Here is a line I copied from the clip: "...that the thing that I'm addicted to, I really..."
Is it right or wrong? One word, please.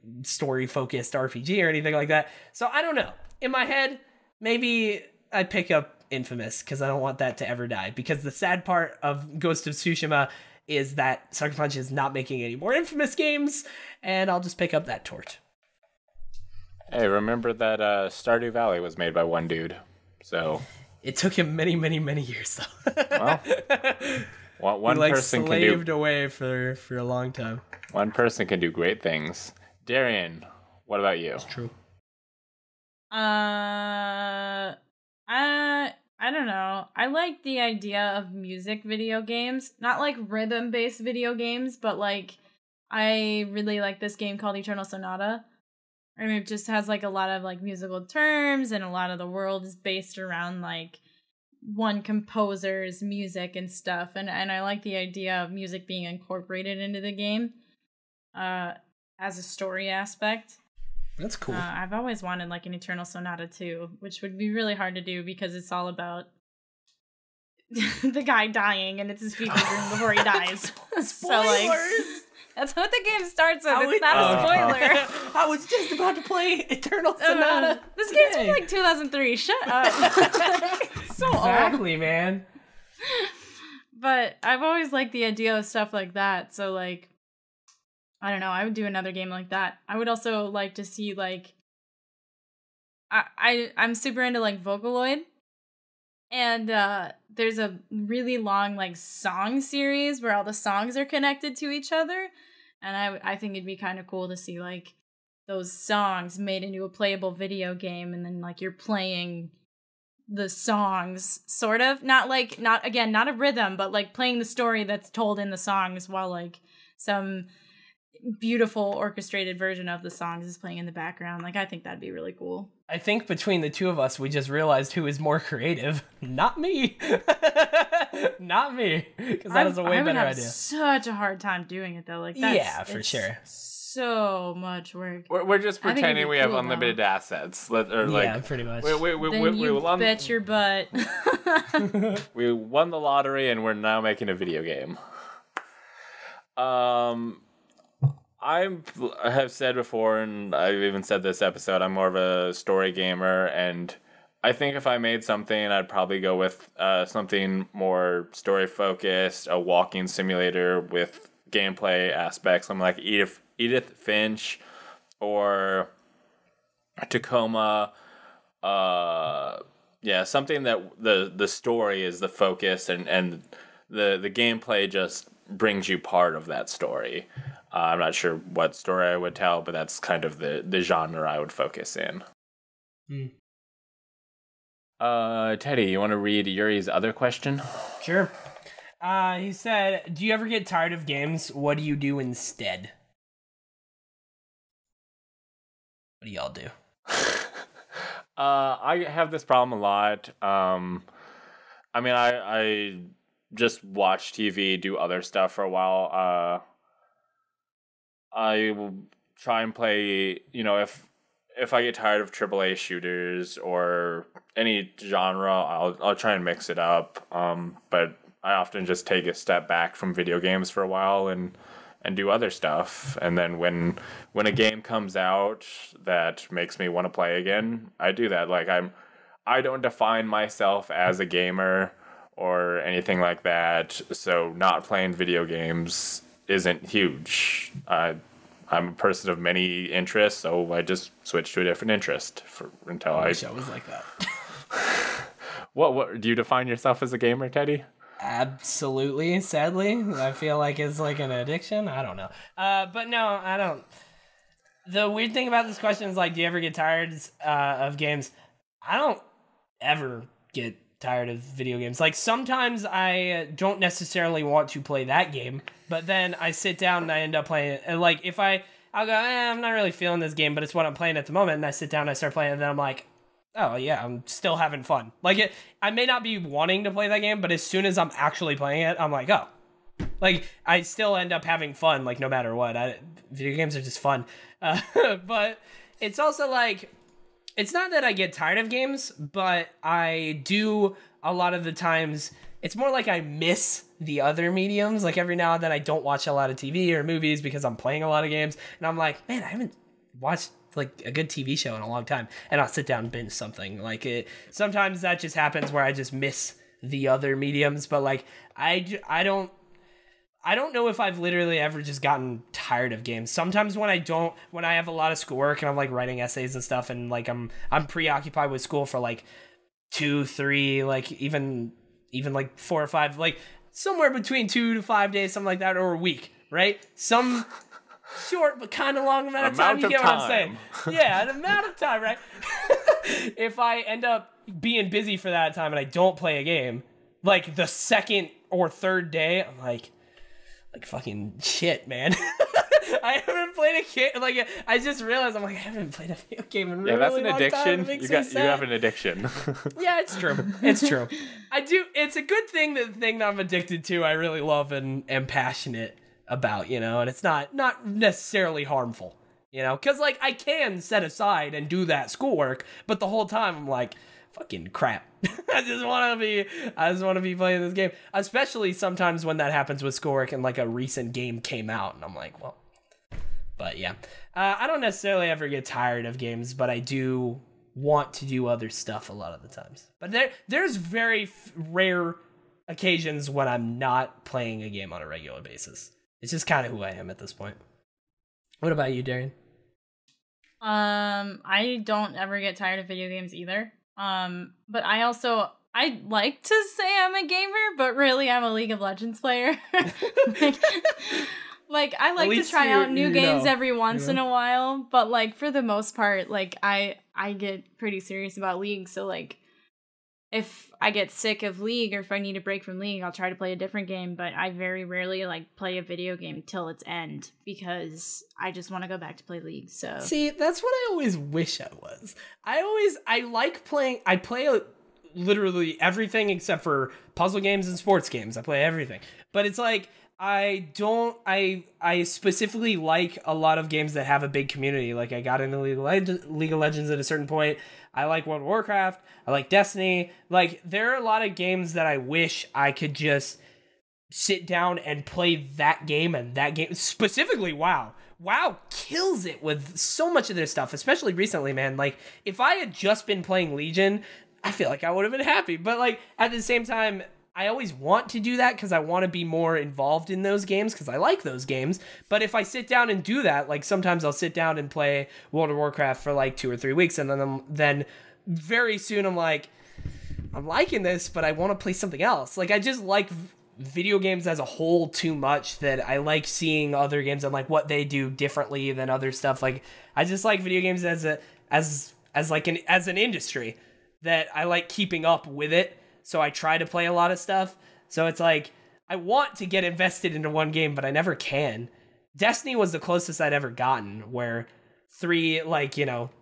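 right.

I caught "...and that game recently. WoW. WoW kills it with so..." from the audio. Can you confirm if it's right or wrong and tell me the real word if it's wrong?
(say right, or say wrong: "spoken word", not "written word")
wrong: "specifically", not "recently".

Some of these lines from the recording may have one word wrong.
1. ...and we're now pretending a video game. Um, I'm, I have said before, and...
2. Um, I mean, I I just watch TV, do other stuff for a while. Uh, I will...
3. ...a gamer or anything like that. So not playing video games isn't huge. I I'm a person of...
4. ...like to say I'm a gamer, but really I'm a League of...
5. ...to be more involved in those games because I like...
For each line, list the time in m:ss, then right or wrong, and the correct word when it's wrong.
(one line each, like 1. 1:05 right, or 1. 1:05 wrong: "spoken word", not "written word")
1. 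2:23 wrong: "making", not "pretending"
2. 3:20 right
3. 3:51 right
4. 6:36 right
5. 7:39 right.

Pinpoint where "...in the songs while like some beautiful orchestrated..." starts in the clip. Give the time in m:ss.
1:55.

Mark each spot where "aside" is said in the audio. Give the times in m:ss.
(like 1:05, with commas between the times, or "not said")
6:01.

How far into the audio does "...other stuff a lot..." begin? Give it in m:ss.
6:18.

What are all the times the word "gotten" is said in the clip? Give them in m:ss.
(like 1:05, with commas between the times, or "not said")
5:12, 8:13.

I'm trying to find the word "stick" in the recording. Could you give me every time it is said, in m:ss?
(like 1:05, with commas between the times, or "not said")
not said.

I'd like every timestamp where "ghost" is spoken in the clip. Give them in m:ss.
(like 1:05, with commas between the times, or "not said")
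0:09.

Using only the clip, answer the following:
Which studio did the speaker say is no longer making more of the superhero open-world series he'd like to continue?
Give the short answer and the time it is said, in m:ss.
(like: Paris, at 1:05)
Sucker Punch, at 0:11.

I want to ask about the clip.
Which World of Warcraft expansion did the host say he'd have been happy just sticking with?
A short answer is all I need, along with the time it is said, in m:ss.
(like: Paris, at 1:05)
Legion, at 7:33.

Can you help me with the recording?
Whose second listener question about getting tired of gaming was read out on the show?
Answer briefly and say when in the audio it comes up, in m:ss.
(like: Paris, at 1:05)
Yuri, at 3:06.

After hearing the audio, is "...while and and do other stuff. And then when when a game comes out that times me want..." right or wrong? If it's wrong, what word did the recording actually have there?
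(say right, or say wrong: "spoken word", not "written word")
wrong: "makes", not "times".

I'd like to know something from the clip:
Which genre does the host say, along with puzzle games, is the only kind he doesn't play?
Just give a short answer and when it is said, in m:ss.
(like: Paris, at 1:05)
Sports games, at 7:07.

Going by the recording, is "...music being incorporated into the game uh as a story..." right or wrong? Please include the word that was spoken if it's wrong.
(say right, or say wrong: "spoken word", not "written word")
right.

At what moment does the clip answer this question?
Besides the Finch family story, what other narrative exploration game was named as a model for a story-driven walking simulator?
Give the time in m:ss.
2:47.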